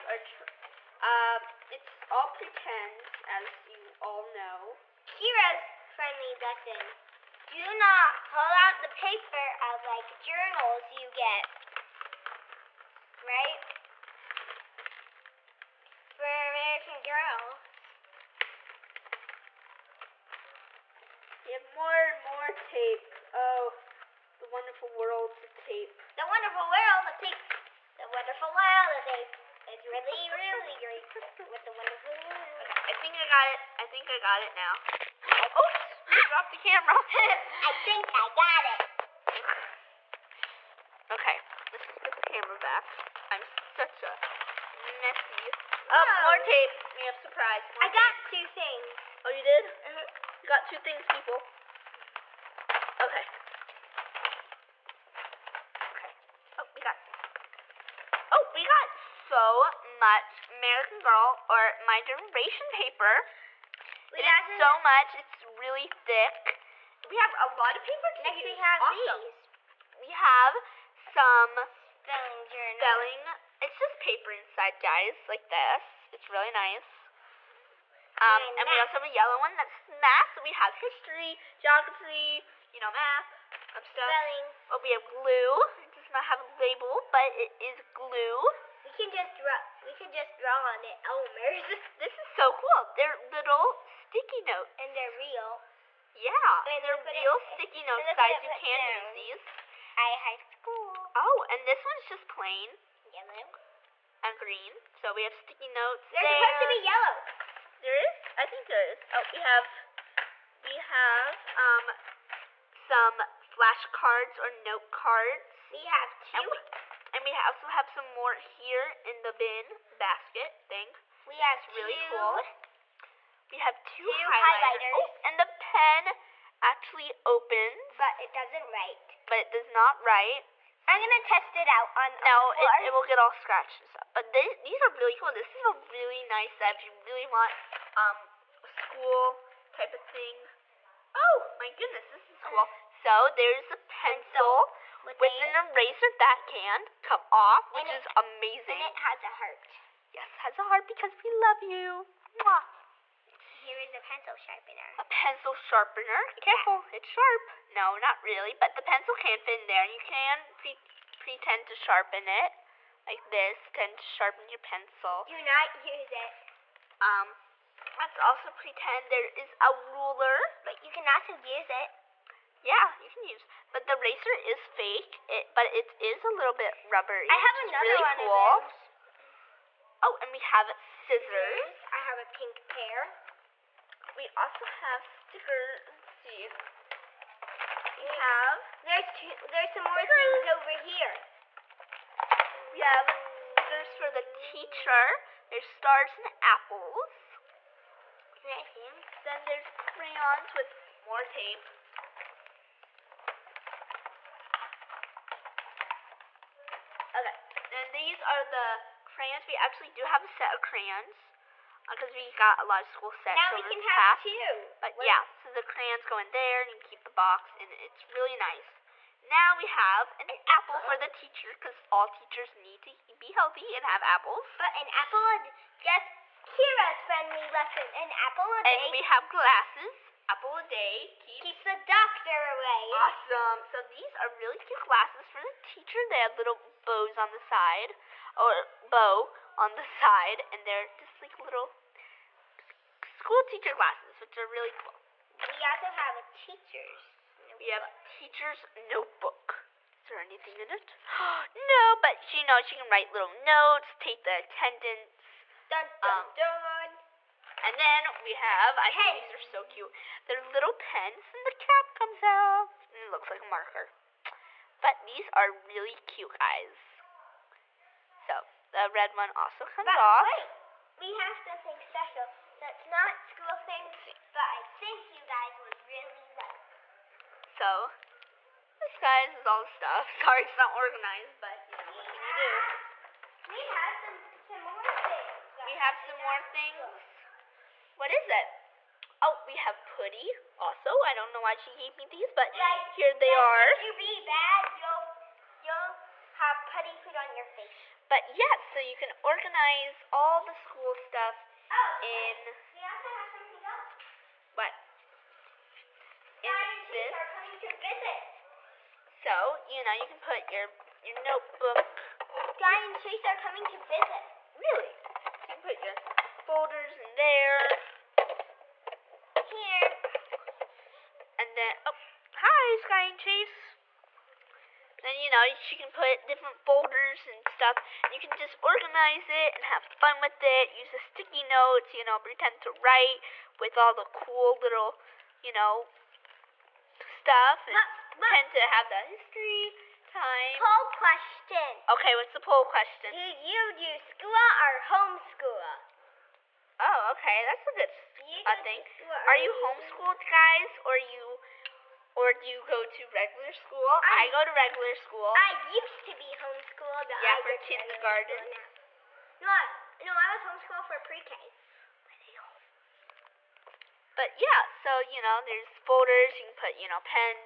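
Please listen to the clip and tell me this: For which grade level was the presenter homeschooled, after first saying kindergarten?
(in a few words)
Pre-K.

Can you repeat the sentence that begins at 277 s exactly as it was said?
So this, guys, is all the stuff.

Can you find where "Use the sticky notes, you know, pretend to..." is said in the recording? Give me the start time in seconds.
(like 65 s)
330 s.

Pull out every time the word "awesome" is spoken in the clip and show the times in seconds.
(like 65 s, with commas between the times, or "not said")
68 s, 232 s.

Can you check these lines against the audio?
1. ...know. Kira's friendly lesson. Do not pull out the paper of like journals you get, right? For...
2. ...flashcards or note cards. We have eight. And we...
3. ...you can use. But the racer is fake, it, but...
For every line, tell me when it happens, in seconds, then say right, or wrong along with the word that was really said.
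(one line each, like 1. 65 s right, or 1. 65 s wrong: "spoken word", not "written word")
1. 4 s right
2. 113 s wrong: "two", not "eight"
3. 173 s right.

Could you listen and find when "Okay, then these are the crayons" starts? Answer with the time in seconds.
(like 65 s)
207 s.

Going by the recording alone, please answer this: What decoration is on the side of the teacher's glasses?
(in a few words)
Bows.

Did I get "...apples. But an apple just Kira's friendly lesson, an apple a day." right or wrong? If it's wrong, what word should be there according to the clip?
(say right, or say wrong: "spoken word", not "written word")
right.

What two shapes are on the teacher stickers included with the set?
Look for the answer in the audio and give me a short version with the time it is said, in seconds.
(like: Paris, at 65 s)
Stars and apples, at 195 s.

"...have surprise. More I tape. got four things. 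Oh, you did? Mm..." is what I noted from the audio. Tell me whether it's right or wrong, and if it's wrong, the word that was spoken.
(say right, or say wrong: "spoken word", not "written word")
wrong: "two", not "four".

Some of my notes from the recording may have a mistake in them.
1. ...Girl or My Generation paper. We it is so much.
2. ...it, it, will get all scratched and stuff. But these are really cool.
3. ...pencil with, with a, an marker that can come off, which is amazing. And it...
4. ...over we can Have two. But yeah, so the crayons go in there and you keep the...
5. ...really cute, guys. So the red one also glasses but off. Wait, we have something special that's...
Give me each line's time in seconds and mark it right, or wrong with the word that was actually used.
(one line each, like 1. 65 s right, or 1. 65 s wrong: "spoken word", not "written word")
1. 60 s right
2. 132 s right
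3. 144 s wrong: "eraser", not "marker"
4. 213 s right
5. 265 s wrong: "comes", not "glasses".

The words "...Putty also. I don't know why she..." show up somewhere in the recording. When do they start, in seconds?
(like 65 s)
289 s.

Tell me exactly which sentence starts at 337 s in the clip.
And but, but, pretend to have the history time.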